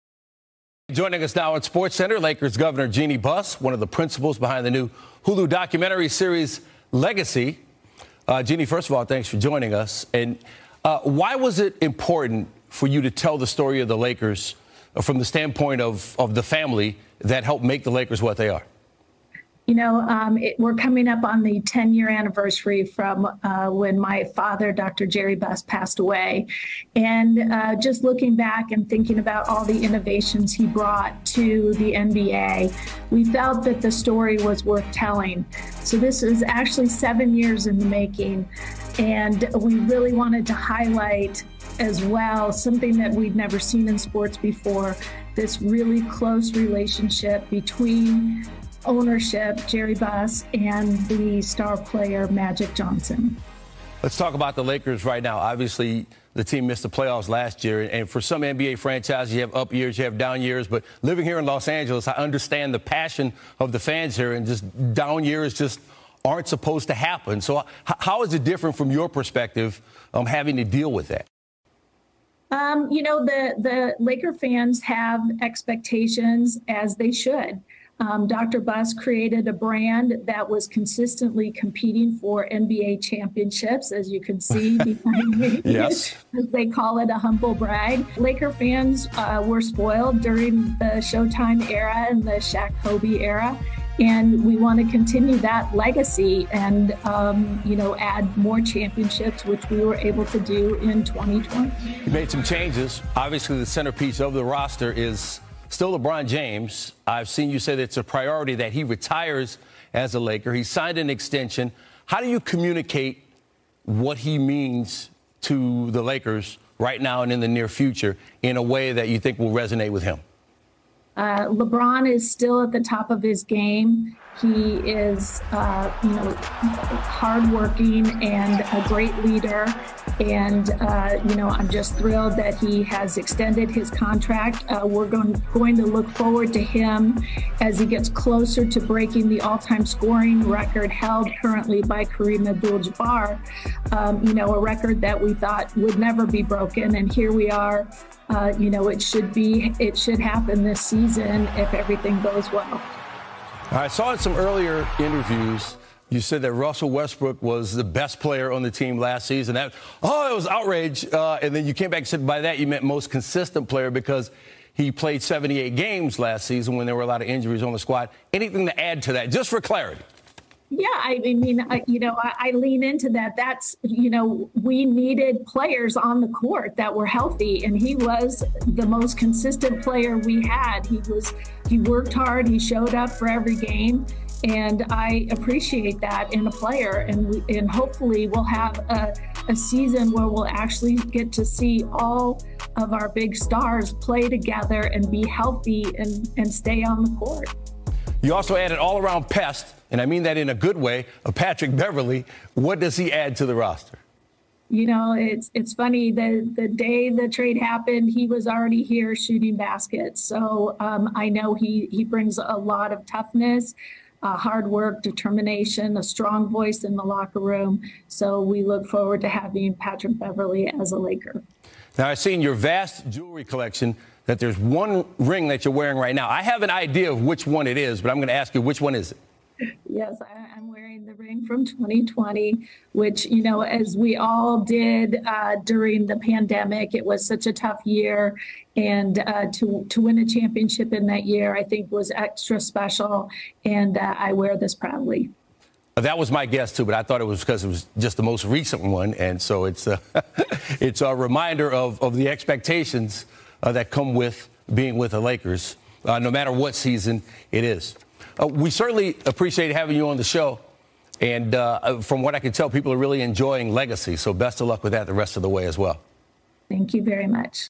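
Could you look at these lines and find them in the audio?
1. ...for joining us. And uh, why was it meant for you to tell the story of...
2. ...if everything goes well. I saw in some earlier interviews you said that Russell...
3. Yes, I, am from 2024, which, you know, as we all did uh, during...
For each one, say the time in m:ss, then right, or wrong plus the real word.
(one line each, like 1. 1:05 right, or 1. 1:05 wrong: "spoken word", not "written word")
1. 0:09 wrong: "important", not "meant"
2. 2:31 right
3. 3:49 wrong: "2020", not "2024".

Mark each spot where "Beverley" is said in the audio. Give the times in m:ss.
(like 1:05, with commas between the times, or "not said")
3:21, 3:40.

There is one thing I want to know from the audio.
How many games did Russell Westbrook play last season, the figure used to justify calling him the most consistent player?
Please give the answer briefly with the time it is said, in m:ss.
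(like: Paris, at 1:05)
78, at 2:45.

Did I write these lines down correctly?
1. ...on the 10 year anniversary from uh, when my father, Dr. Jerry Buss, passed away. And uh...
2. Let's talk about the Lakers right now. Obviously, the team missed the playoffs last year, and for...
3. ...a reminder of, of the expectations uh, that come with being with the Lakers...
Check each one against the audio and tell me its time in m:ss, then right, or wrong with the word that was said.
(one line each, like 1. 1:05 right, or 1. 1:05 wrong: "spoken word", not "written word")
1. 0:21 right
2. 0:54 right
3. 4:11 right.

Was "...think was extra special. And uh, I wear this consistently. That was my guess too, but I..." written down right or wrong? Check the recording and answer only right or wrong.
wrong.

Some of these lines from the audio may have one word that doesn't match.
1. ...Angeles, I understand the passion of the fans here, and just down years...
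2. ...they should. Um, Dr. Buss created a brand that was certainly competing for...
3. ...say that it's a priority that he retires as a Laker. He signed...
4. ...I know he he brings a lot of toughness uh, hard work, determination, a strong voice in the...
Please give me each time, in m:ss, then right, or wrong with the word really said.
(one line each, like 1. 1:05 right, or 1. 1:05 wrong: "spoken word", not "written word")
1. 1:01 right
2. 1:16 wrong: "consistently", not "certainly"
3. 1:47 right
4. 3:31 right.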